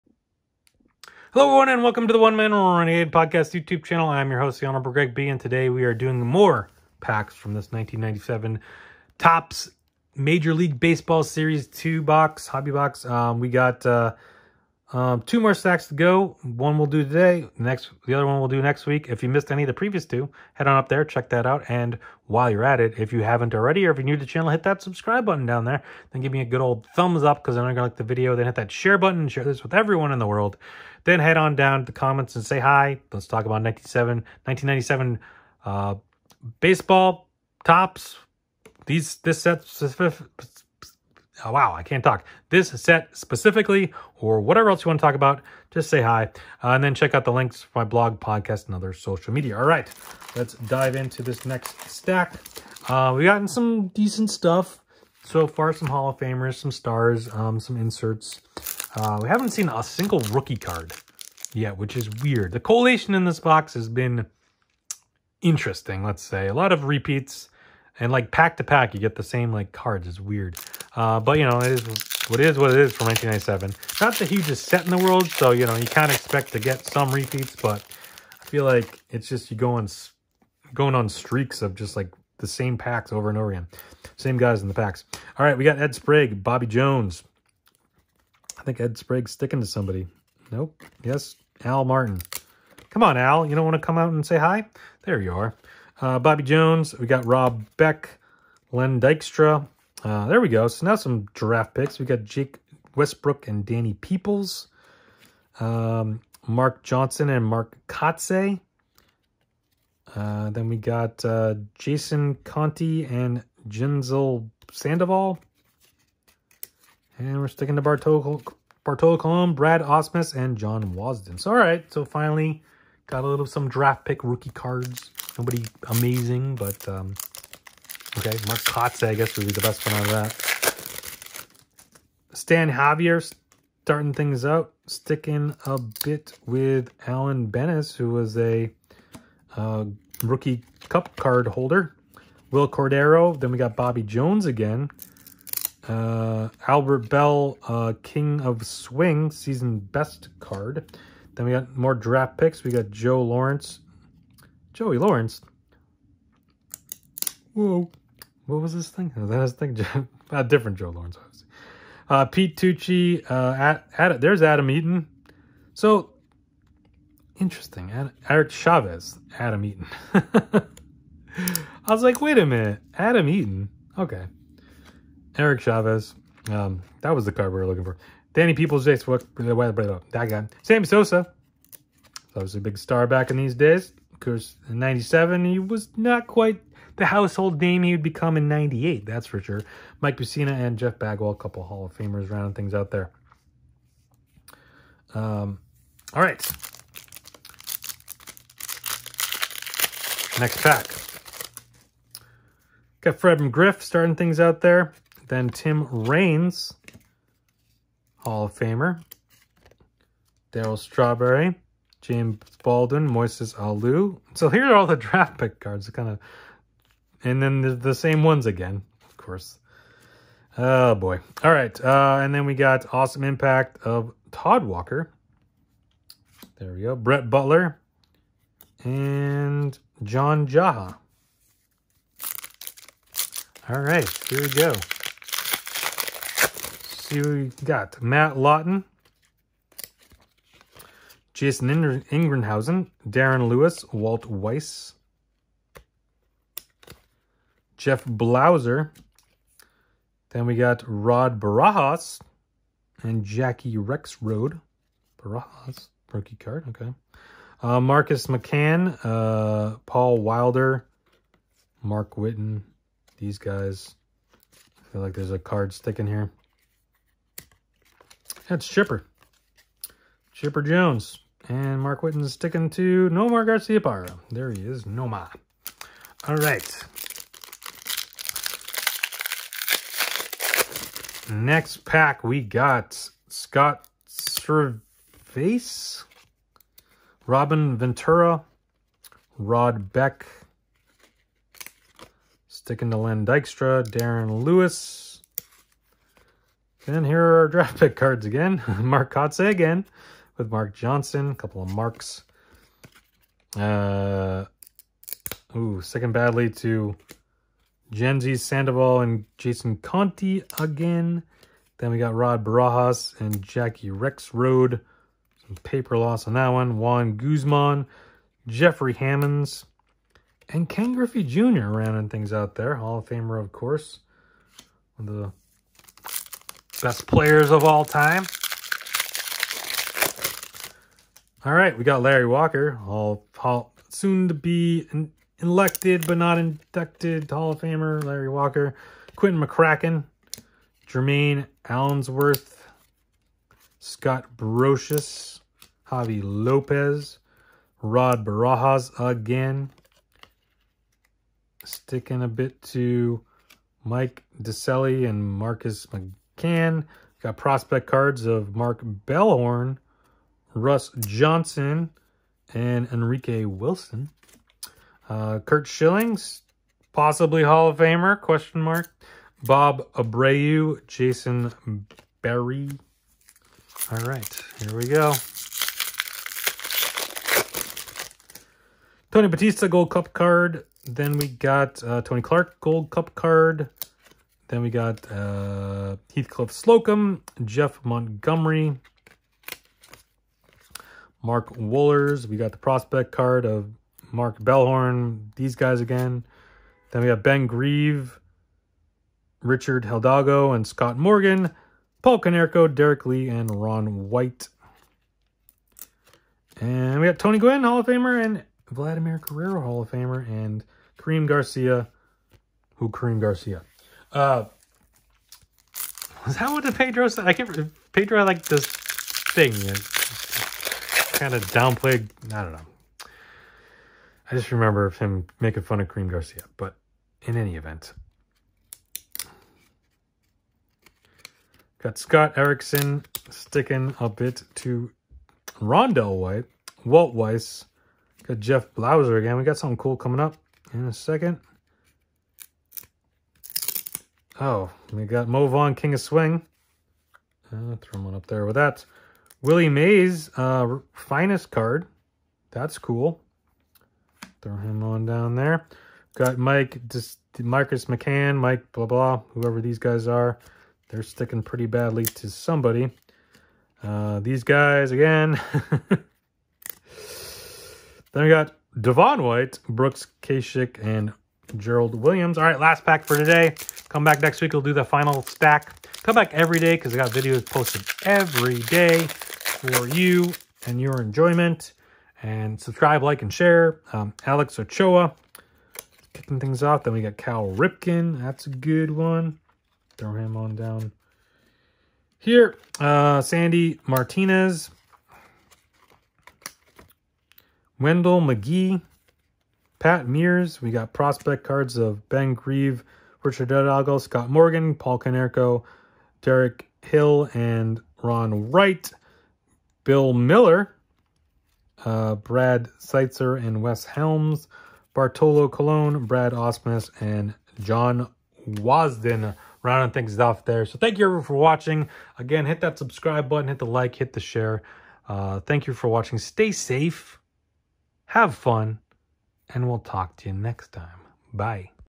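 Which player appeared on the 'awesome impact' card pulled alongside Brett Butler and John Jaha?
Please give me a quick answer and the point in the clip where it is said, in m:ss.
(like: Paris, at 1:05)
Todd Walker, at 3:44.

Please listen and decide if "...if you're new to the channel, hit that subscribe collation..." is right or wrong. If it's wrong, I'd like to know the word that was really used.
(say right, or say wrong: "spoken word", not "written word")
wrong: "button", not "collation".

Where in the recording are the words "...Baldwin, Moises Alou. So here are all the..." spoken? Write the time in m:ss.
3:32.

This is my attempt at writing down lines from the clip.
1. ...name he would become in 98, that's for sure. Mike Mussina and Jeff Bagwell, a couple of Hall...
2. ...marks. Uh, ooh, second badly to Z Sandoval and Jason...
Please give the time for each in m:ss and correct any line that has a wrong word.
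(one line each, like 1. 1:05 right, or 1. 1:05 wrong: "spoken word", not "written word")
1. 3:07 right
2. 5:01 right.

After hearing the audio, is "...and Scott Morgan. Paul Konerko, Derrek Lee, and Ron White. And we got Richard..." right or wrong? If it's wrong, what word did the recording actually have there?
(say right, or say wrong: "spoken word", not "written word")
wrong: "Tony", not "Richard".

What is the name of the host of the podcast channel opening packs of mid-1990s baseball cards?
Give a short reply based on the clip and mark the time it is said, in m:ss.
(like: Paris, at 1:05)
the Honorable Greg B, at 0:04.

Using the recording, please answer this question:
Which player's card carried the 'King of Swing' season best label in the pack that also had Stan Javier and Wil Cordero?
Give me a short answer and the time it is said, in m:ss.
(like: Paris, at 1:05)
Albert Belle, at 2:26.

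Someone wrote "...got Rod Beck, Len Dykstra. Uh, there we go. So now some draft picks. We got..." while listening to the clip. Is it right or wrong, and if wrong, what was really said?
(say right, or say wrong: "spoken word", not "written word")
right.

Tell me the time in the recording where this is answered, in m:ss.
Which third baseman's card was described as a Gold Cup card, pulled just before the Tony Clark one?
6:19.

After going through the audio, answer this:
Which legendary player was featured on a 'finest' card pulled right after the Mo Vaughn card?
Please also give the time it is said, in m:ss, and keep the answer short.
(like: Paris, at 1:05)
Willie Mays, at 7:29.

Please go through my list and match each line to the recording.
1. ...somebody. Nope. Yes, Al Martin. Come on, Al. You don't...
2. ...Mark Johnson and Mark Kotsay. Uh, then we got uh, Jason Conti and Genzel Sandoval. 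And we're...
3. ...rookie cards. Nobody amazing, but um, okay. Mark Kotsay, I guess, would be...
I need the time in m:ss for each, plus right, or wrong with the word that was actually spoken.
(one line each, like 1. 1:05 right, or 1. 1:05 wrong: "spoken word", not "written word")
1. 1:29 right
2. 1:46 right
3. 2:04 right.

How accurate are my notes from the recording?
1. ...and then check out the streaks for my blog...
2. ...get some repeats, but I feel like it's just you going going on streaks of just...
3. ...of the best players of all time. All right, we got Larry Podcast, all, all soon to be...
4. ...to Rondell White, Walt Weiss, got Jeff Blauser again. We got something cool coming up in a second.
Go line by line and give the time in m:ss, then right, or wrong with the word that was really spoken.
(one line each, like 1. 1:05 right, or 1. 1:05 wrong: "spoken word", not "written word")
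1. 0:46 wrong: "links", not "streaks"
2. 1:16 right
3. 5:25 wrong: "Walker", not "Podcast"
4. 7:14 right.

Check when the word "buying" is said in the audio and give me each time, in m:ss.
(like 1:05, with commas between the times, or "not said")
not said.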